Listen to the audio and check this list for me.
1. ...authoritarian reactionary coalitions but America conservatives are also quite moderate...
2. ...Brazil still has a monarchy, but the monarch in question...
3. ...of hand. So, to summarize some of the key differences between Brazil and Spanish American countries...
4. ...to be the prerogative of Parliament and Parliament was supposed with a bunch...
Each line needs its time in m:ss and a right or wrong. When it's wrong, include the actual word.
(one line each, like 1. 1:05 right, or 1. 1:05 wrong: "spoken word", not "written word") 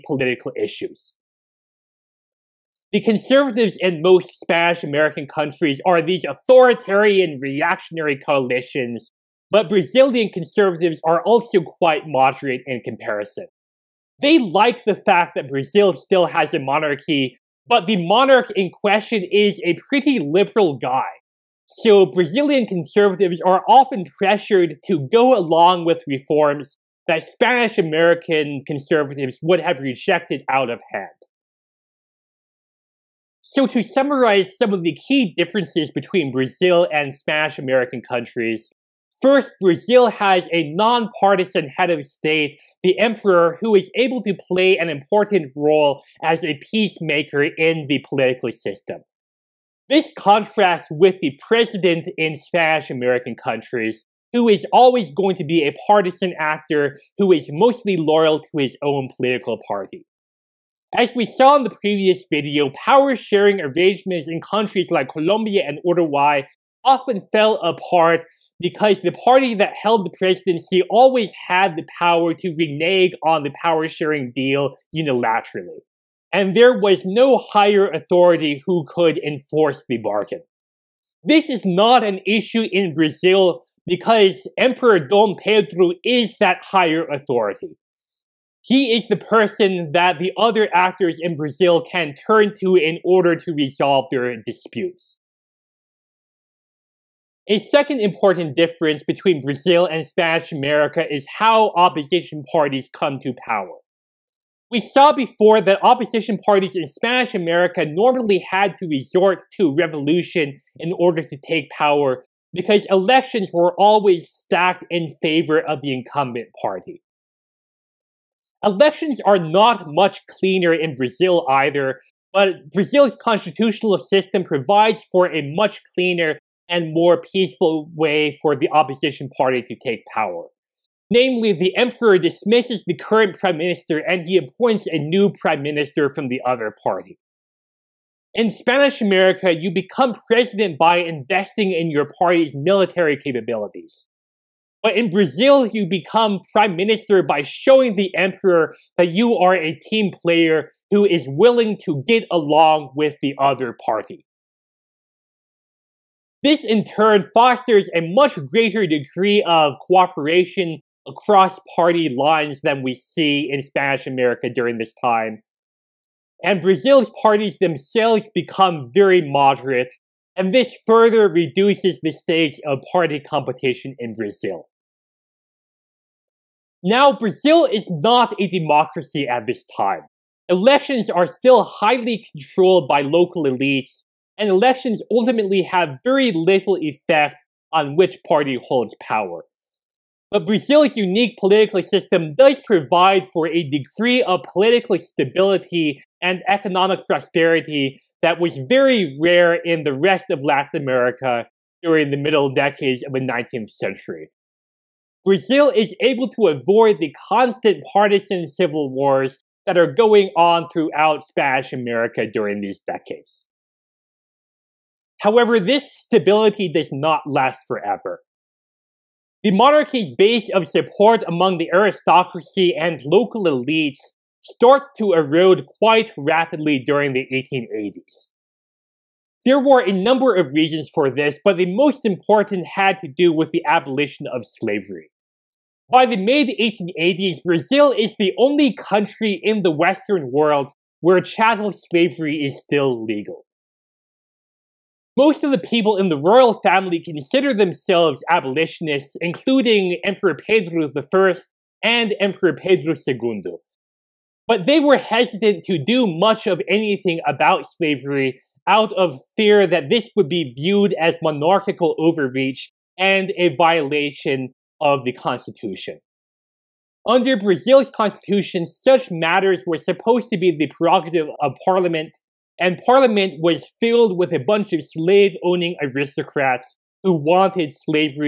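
1. 0:06 wrong: "Brazilian", not "America"
2. 0:15 right
3. 0:30 right
4. 4:30 wrong: "filled", not "supposed".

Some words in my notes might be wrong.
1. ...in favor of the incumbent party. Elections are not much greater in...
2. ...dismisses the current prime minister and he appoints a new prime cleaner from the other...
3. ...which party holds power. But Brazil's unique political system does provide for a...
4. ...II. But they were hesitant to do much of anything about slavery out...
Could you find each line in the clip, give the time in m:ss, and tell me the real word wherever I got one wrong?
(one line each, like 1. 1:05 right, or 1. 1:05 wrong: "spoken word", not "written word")
1. 1:54 wrong: "cleaner", not "greater"
2. 2:12 wrong: "minister", not "cleaner"
3. 3:07 right
4. 4:13 right.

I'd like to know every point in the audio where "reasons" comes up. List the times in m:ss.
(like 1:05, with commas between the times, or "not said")
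3:50.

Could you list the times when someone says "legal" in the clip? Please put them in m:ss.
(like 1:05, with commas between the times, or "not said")
4:03.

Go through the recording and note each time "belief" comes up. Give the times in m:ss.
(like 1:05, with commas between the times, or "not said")
not said.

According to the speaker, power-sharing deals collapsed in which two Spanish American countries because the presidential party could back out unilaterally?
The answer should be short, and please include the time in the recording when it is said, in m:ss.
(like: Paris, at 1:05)
Colombia and Uruguay, at 1:05.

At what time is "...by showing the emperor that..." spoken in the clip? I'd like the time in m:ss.
2:27.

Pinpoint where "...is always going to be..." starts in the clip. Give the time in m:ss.
0:54.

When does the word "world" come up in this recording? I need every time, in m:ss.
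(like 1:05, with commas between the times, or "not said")
4:00.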